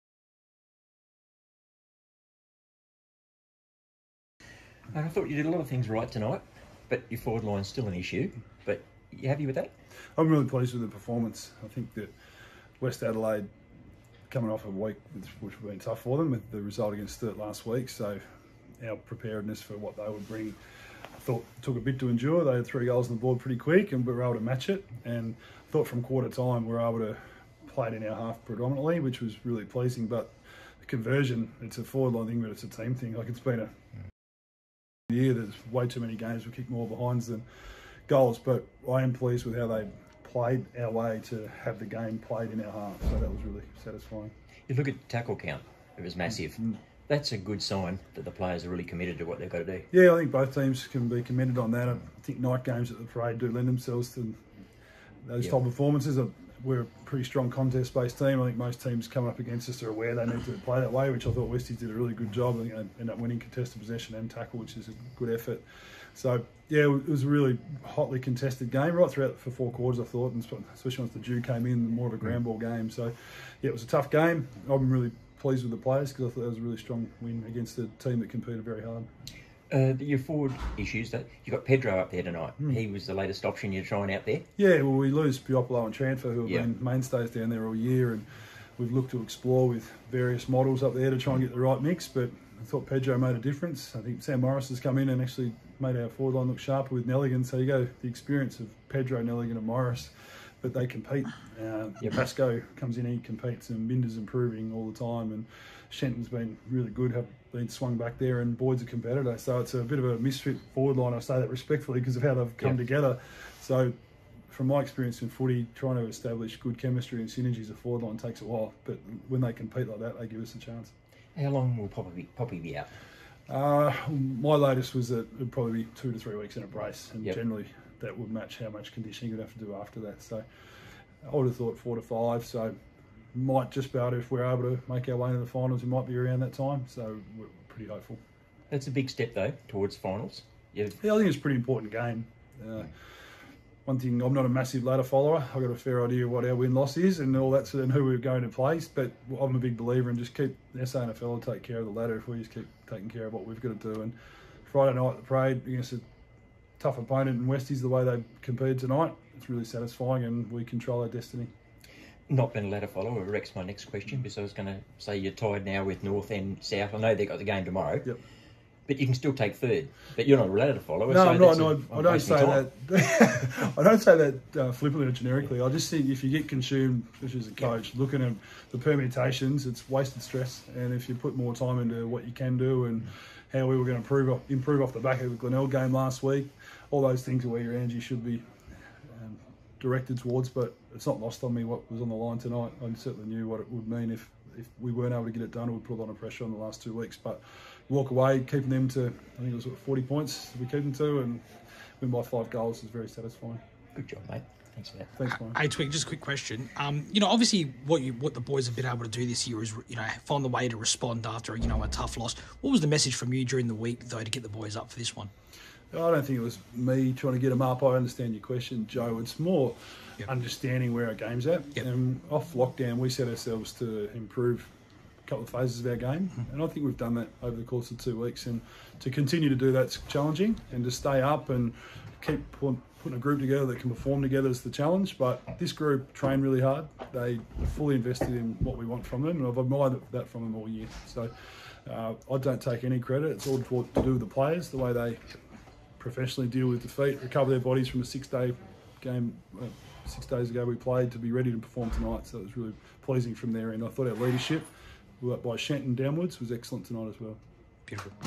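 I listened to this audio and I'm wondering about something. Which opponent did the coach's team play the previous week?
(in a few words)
Glenelg.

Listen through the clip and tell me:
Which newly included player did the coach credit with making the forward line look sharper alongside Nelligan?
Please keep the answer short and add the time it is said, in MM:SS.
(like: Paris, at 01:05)
Sam Morris, at 01:34.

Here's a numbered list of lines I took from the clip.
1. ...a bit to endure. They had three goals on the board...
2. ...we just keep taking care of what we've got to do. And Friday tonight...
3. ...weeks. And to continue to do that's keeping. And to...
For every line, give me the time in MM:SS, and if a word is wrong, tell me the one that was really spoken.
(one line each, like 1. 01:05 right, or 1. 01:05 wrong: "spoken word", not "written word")
1. 00:21 right
2. 02:32 wrong: "night", not "tonight"
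3. 03:48 wrong: "challenging", not "keeping".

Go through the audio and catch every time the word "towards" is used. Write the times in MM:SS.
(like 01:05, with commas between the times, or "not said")
02:19, 03:10.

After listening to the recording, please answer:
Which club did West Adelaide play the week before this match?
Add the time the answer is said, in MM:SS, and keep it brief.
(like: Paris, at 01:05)
Sturt, at 00:17.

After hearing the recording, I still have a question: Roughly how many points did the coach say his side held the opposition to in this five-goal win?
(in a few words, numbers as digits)
40.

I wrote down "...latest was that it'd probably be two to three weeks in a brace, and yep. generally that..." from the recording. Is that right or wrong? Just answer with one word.
right.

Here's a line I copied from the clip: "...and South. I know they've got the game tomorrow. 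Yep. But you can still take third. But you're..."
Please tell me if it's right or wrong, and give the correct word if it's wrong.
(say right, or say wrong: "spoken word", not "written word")
right.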